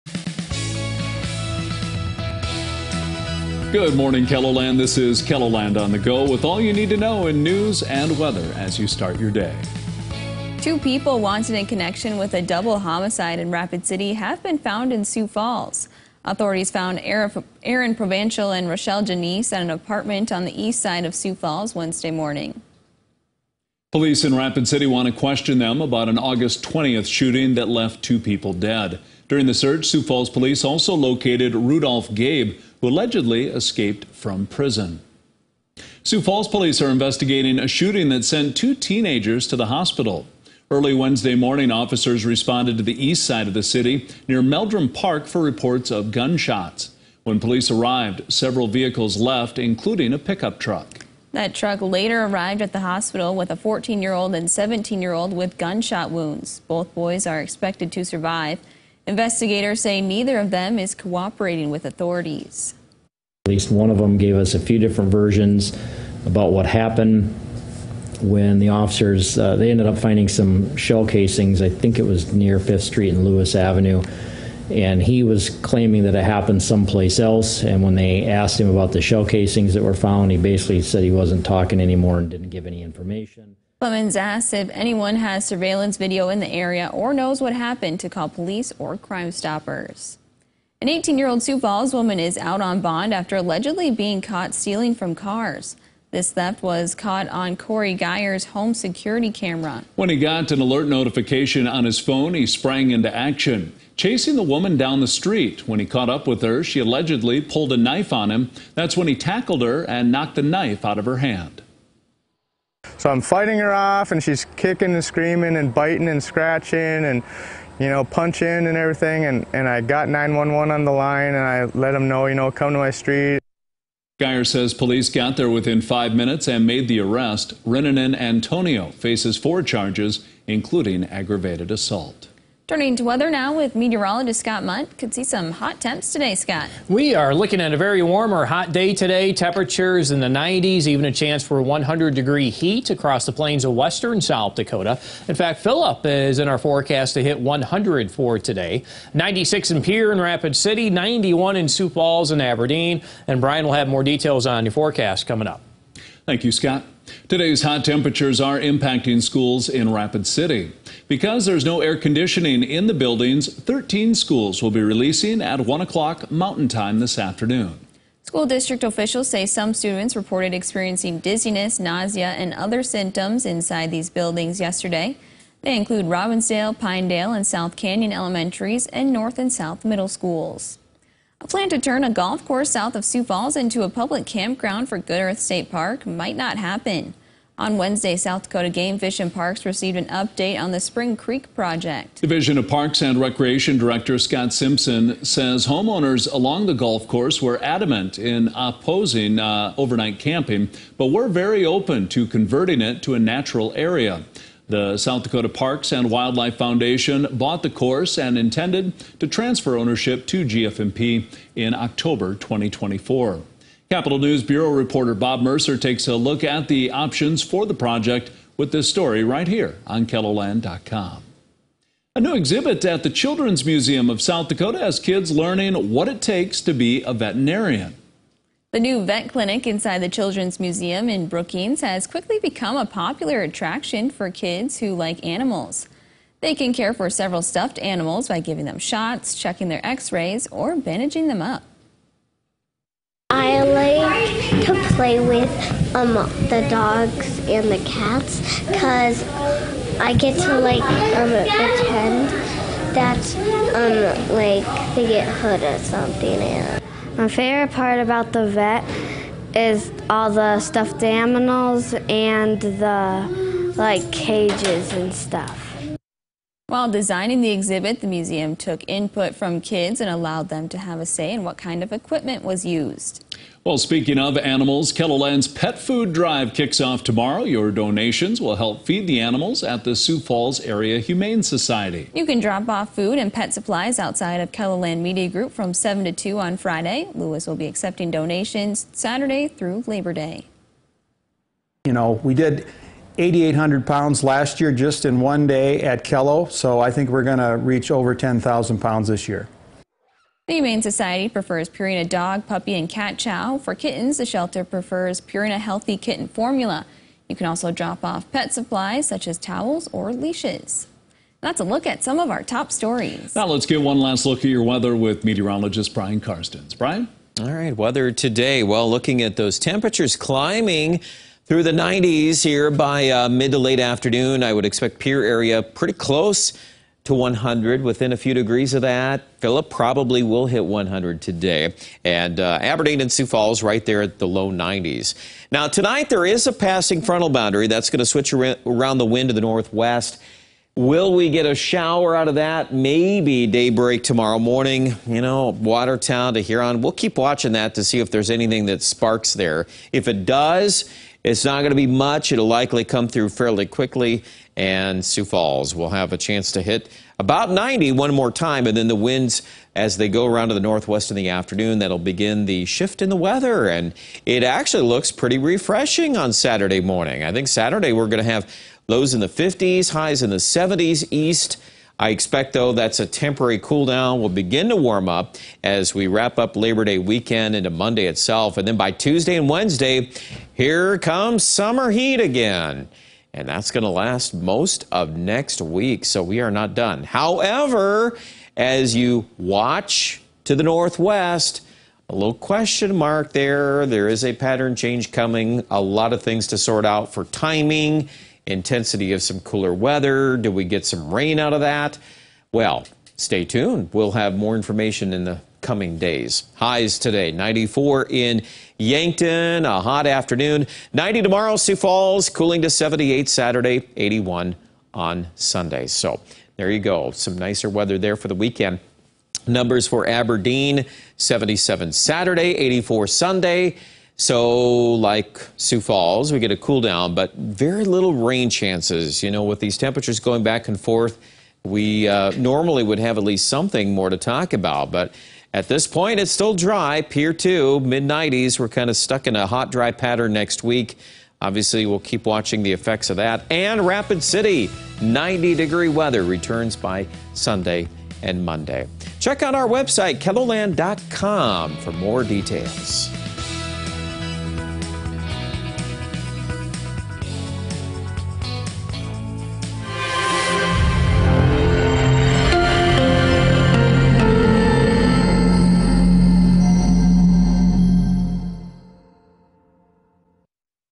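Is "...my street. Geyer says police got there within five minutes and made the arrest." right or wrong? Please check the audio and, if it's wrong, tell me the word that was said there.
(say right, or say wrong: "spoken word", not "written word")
right.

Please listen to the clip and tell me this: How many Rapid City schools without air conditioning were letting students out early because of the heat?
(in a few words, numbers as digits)
13.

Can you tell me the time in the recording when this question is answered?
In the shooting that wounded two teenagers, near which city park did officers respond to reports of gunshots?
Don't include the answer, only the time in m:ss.
0:44.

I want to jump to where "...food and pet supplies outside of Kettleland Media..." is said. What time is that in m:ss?
4:42.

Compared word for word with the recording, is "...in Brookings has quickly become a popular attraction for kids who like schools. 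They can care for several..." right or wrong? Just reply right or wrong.
wrong.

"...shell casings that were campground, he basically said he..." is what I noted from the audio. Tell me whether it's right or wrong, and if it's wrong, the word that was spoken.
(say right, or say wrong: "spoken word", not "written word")
wrong: "found", not "campground".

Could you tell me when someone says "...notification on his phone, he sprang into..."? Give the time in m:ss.
1:40.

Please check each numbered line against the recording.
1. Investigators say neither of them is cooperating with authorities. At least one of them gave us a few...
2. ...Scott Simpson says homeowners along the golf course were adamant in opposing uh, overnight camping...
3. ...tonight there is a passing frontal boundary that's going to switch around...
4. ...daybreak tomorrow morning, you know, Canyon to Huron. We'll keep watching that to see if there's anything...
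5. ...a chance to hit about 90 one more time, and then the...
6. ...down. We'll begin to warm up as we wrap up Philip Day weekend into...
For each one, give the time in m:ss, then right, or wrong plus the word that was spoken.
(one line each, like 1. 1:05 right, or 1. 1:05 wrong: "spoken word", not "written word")
1. 0:59 right
2. 3:14 right
3. 5:35 right
4. 5:43 wrong: "Watertown", not "Canyon"
5. 5:56 right
6. 6:13 wrong: "Labor", not "Philip".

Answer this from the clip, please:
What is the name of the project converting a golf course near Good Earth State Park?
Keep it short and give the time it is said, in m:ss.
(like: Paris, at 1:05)
Spring Creek, at 3:10.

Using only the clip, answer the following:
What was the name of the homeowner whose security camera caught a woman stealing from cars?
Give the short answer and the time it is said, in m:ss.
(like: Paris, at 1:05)
Corey Geyer, at 1:37.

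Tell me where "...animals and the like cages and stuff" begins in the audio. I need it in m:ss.
4:21.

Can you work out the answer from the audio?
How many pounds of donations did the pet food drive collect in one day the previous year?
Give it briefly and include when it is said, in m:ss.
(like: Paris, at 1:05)
8,800, at 4:53.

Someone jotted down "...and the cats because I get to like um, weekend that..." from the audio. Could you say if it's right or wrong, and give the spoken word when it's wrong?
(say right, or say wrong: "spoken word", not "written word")
wrong: "pretend", not "weekend".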